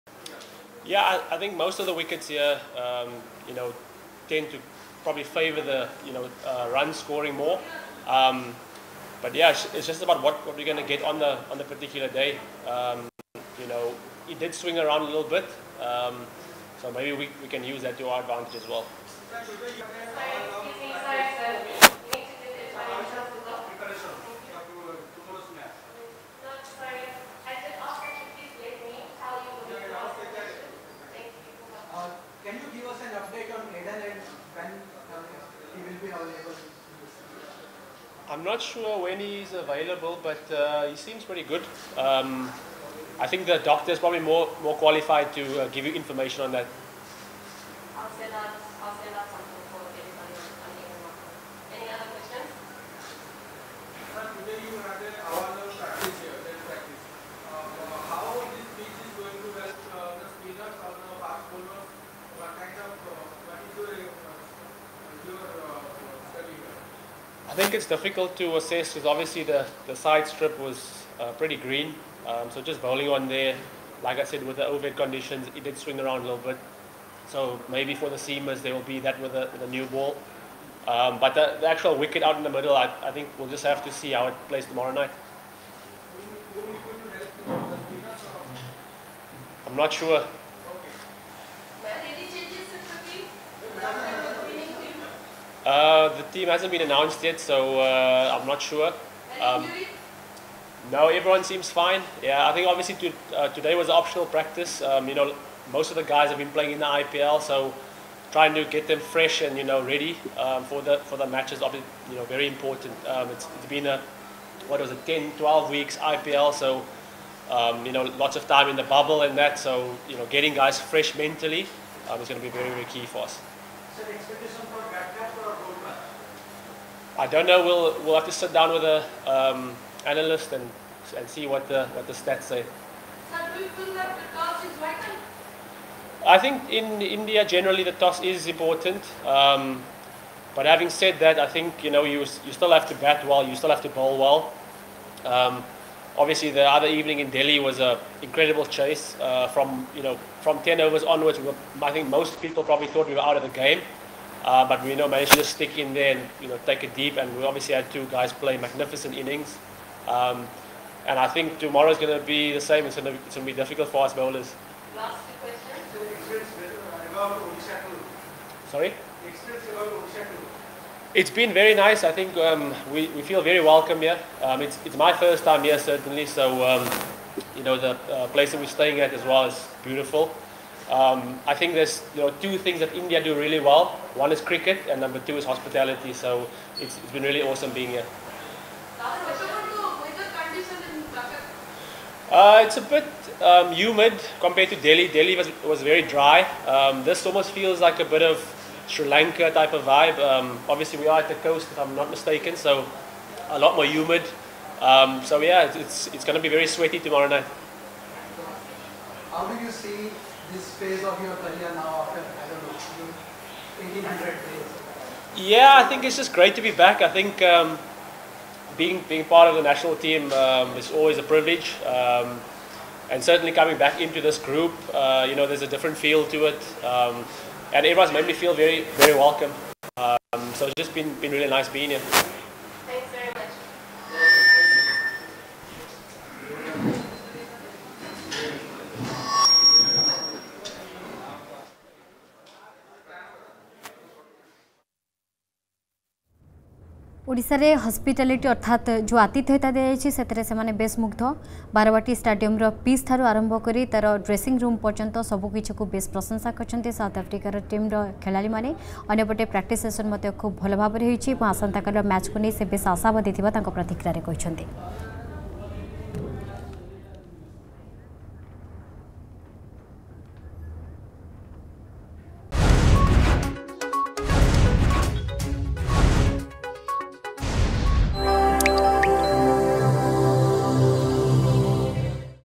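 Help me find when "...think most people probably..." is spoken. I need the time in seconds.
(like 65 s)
151 s.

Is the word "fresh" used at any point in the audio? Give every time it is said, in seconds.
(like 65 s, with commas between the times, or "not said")
108 s, 120 s.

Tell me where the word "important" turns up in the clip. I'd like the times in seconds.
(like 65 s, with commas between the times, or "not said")
112 s, 138 s.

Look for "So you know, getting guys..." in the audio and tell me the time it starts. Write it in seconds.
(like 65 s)
119 s.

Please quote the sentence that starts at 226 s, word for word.
Um, and everyone's made me feel very, very welcome.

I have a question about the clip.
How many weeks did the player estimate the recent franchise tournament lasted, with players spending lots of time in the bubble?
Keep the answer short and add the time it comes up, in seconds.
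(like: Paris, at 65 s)
10-12 weeks, at 115 s.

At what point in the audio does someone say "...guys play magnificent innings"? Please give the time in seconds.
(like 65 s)
158 s.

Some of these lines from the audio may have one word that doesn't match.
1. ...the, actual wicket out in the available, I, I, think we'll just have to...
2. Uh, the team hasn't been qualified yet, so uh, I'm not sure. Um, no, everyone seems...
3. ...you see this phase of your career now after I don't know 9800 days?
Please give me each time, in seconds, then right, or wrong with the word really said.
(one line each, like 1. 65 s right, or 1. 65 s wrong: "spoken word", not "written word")
1. 81 s wrong: "middle", not "available"
2. 95 s wrong: "announced", not "qualified"
3. 209 s wrong: "1800", not "9800".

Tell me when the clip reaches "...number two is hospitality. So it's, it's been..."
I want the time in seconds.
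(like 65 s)
185 s.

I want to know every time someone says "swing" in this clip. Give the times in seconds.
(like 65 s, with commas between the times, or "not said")
14 s, 75 s.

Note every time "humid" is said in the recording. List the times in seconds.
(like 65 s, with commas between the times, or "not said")
193 s, 203 s.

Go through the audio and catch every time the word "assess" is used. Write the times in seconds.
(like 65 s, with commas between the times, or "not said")
68 s.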